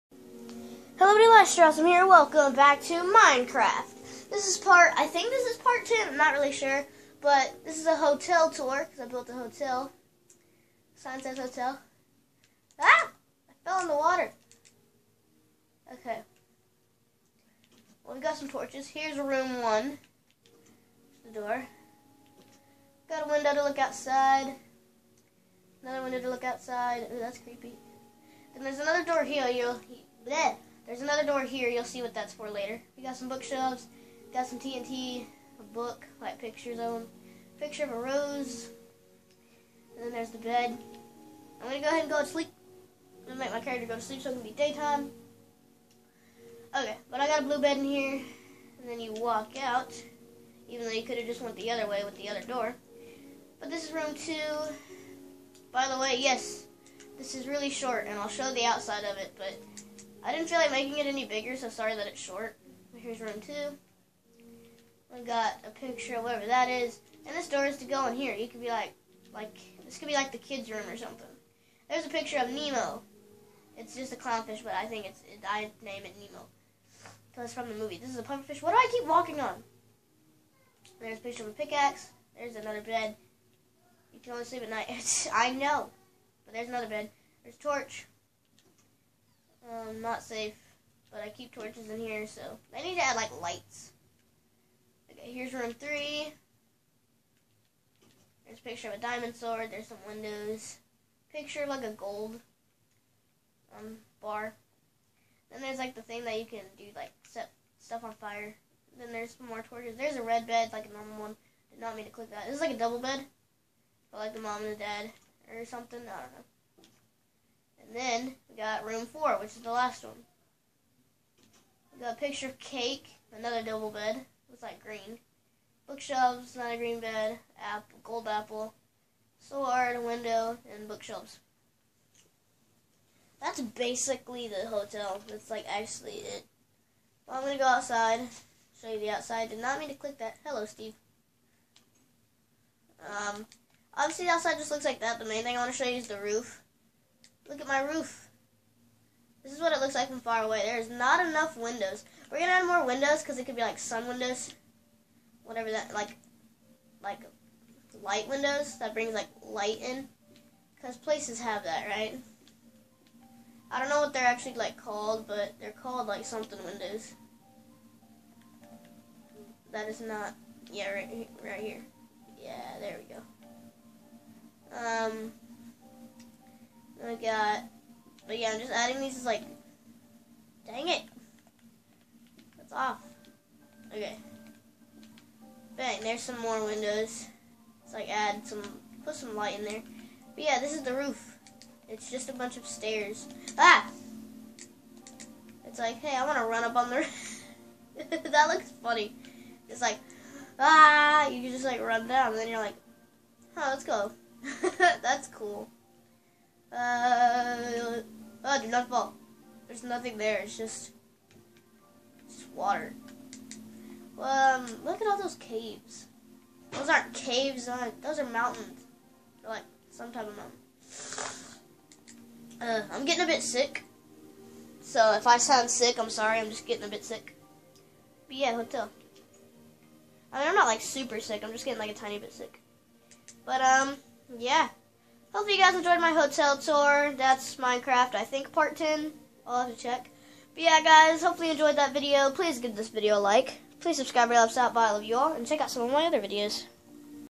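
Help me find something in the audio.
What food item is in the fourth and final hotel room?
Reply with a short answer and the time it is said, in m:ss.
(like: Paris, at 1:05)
Cake, at 2:02.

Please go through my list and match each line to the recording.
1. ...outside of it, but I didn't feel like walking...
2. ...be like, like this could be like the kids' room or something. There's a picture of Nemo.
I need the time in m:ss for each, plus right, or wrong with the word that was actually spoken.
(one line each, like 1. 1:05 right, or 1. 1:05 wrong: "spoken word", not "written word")
1. 0:58 wrong: "making", not "walking"
2. 1:08 right.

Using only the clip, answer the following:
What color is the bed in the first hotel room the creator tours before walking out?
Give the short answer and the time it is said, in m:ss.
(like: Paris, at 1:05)
Blue, at 0:47.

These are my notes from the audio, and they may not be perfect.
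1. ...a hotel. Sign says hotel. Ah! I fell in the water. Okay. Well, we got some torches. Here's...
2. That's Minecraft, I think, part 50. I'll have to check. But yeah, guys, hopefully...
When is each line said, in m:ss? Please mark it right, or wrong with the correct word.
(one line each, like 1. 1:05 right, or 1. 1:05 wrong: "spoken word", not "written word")
1. 0:09 right
2. 3:57 wrong: "10", not "50".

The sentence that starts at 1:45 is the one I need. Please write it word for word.
Then there's like the thing that you can do like set stuff on fire.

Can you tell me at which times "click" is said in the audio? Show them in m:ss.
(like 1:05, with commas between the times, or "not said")
1:52, 2:19.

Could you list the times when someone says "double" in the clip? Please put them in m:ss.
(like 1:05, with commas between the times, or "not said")
1:52, 2:03.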